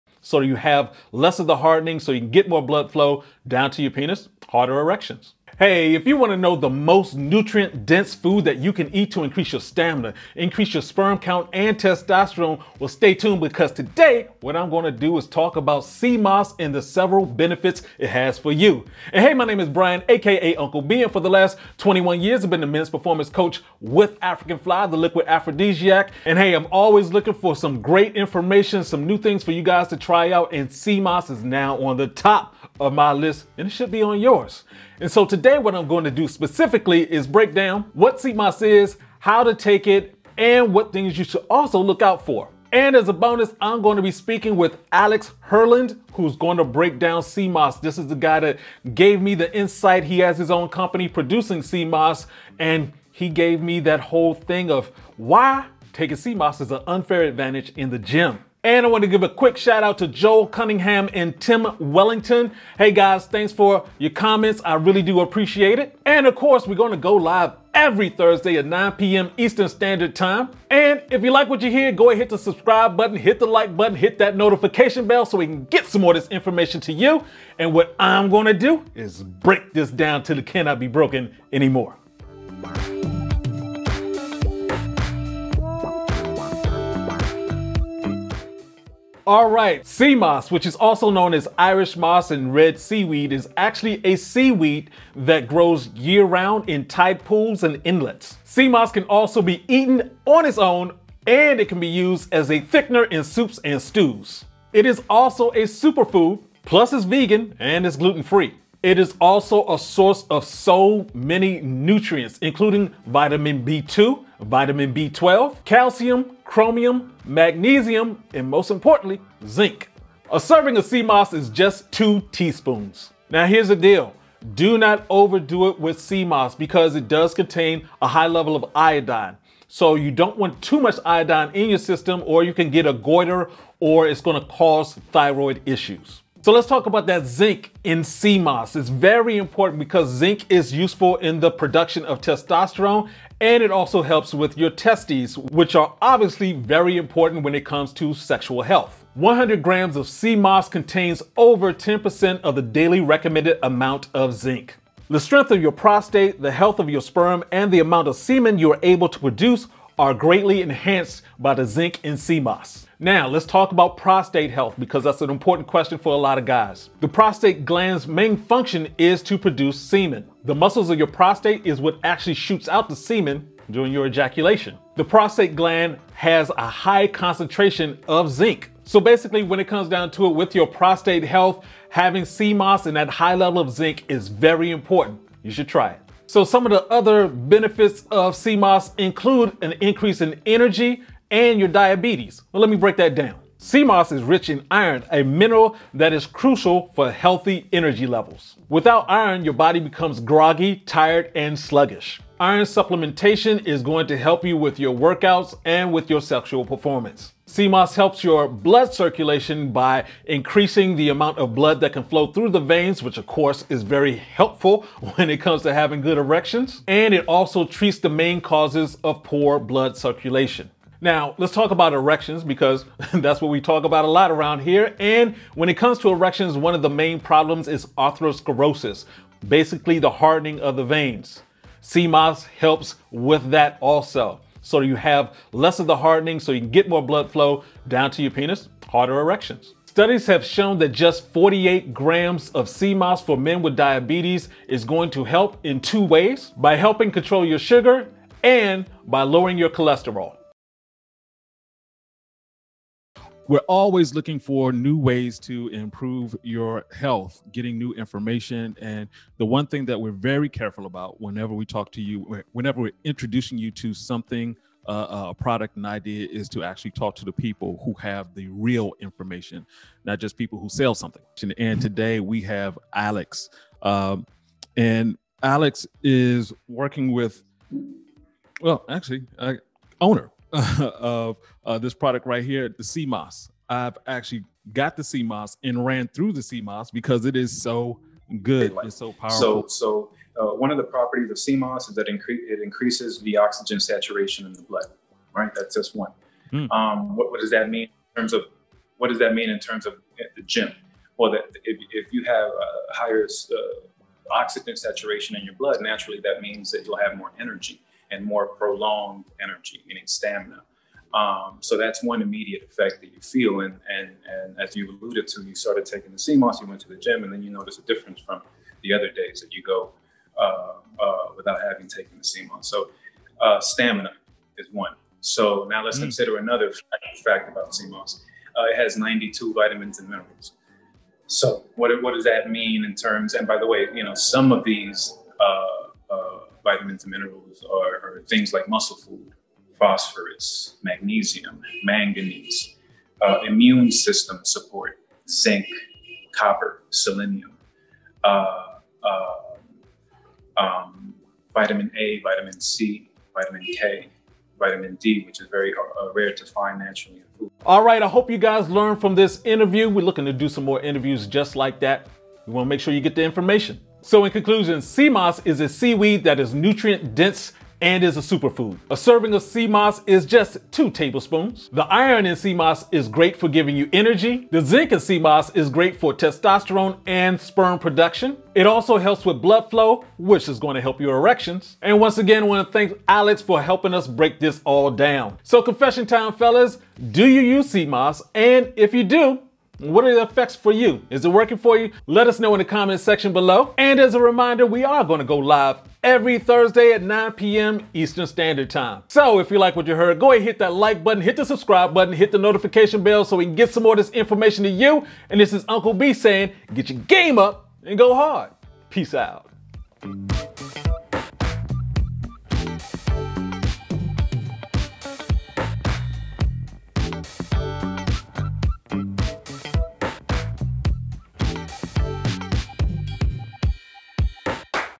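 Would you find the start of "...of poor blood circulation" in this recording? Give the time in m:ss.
3:39.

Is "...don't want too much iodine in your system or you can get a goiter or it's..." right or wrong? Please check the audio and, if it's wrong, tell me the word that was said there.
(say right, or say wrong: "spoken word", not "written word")
right.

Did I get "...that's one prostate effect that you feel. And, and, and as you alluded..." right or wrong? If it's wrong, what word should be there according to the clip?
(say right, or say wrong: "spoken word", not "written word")
wrong: "immediate", not "prostate".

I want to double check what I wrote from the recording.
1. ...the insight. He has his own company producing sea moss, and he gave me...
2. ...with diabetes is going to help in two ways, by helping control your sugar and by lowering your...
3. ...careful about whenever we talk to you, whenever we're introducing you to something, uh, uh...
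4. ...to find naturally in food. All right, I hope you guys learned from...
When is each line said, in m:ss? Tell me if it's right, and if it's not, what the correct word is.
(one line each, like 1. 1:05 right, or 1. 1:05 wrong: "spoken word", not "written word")
1. 0:49 right
2. 4:03 right
3. 4:20 right
4. 5:56 right.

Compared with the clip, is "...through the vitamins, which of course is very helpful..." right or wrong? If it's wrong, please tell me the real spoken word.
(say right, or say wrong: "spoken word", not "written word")
wrong: "veins", not "vitamins".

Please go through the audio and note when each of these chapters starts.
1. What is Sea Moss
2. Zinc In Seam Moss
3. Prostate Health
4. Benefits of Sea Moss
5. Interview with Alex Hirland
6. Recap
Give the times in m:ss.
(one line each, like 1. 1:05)
1. 1:29
2. 2:16
3. 2:44
4. 3:06
5. 4:10
6. 5:57.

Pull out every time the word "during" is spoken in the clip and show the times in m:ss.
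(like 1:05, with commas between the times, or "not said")
2:53.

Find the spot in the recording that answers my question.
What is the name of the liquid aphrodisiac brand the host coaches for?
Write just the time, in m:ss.
0:24.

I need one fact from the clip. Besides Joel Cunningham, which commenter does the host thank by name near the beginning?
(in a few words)
Tim Wellington.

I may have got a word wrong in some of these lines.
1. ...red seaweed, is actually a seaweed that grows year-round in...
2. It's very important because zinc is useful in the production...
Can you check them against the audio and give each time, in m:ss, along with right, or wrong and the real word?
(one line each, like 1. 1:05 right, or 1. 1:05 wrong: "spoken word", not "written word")
1. 1:32 right
2. 2:18 right.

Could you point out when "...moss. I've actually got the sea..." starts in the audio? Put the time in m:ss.
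4:43.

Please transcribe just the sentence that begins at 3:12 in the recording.
Well, let me break that down.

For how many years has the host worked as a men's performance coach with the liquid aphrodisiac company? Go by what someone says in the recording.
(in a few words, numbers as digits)
21 years.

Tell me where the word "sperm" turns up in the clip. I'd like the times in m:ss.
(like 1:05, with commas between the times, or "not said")
0:10, 2:37, 6:17.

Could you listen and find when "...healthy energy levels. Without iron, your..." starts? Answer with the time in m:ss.
3:17.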